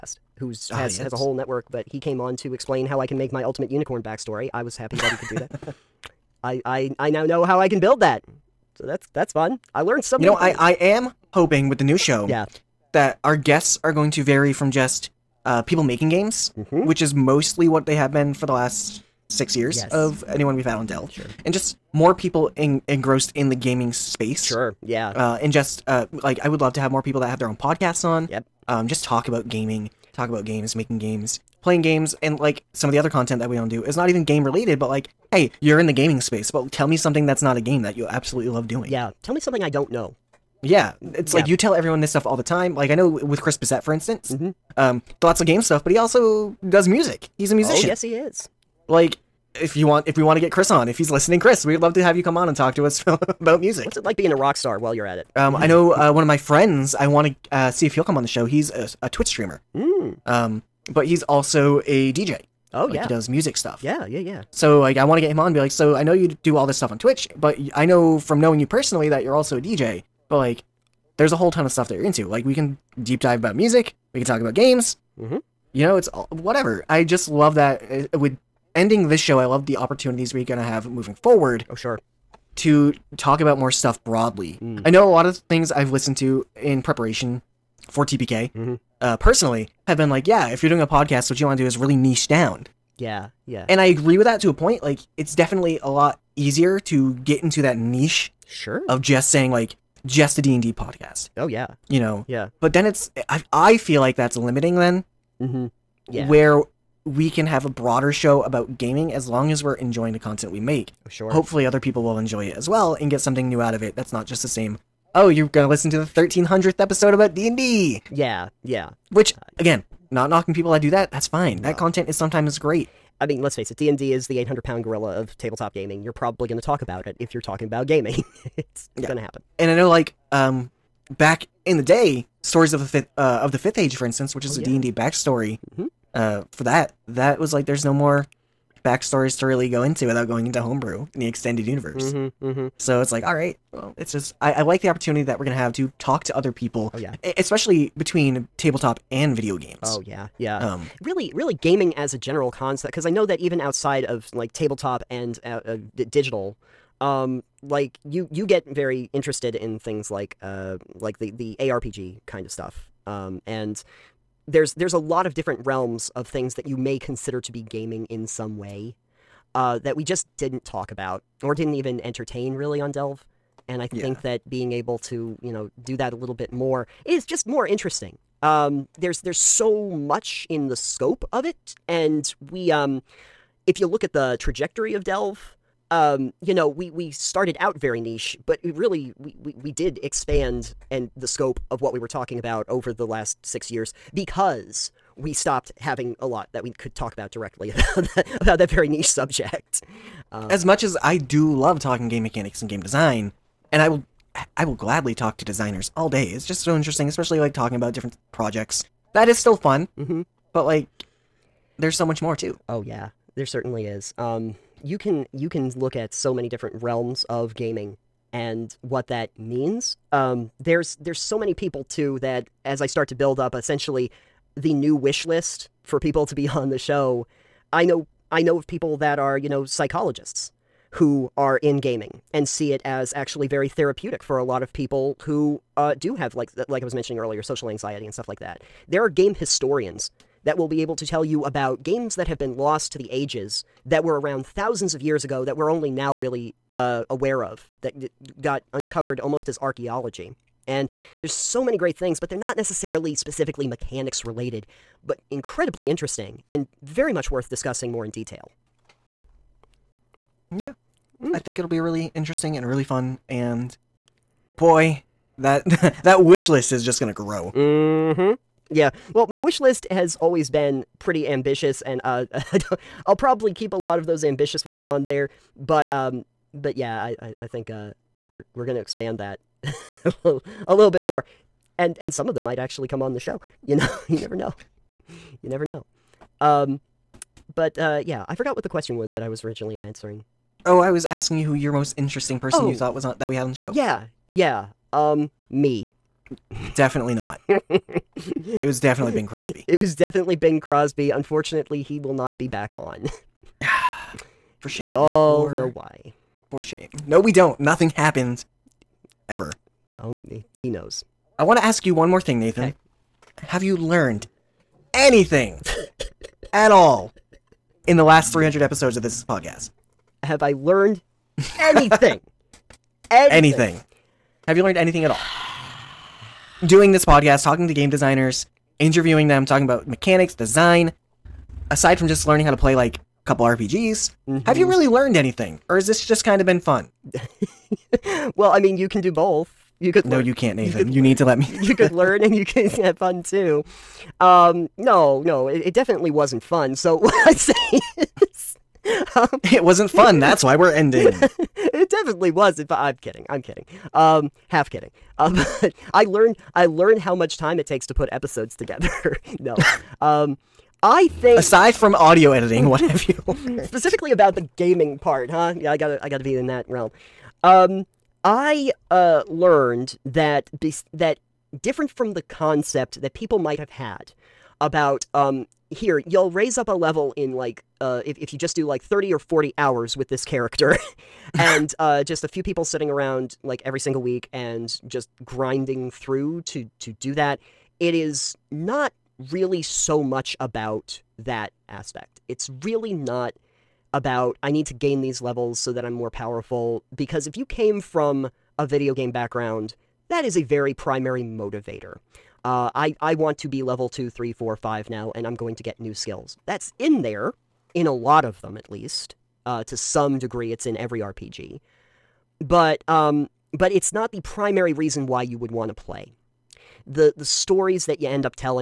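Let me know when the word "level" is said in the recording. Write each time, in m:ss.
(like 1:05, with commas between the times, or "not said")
6:16, 6:35, 6:43.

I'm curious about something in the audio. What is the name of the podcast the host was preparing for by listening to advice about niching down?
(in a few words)
TPK.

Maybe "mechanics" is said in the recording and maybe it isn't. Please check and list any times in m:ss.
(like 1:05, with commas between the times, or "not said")
3:22, 4:13, 5:29.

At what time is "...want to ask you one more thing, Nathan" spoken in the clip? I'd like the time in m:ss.
5:11.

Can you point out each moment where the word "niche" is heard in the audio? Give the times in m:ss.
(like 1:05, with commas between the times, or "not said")
1:31, 1:37, 3:07, 3:18.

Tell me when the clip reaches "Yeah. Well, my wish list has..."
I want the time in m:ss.
4:28.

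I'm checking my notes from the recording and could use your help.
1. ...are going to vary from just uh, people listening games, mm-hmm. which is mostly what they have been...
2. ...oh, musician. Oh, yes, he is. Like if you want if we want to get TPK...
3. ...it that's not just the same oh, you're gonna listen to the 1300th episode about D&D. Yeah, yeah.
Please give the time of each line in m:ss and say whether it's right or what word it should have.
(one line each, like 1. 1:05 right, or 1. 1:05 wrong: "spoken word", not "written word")
1. 0:13 wrong: "making", not "listening"
2. 0:47 wrong: "Chris", not "TPK"
3. 1:53 right.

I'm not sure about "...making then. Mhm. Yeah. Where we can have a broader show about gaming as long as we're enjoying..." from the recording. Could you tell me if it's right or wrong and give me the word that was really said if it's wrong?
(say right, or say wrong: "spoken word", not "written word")
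wrong: "limiting", not "making".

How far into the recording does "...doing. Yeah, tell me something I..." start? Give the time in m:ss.
0:38.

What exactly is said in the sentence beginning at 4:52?
you thought was on, that we had on the show.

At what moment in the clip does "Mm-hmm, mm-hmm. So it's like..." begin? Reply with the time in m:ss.
2:22.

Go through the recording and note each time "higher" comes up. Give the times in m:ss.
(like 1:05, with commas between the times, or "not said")
not said.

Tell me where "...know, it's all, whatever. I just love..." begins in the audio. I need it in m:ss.
1:15.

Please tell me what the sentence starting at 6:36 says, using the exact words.
Because if you came from a video game background, that is a very primary motivator.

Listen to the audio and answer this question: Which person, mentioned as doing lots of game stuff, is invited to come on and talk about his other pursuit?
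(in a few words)
Chris Bissette.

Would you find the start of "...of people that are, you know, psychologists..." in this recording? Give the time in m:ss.
3:48.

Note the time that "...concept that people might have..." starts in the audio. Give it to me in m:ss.
6:12.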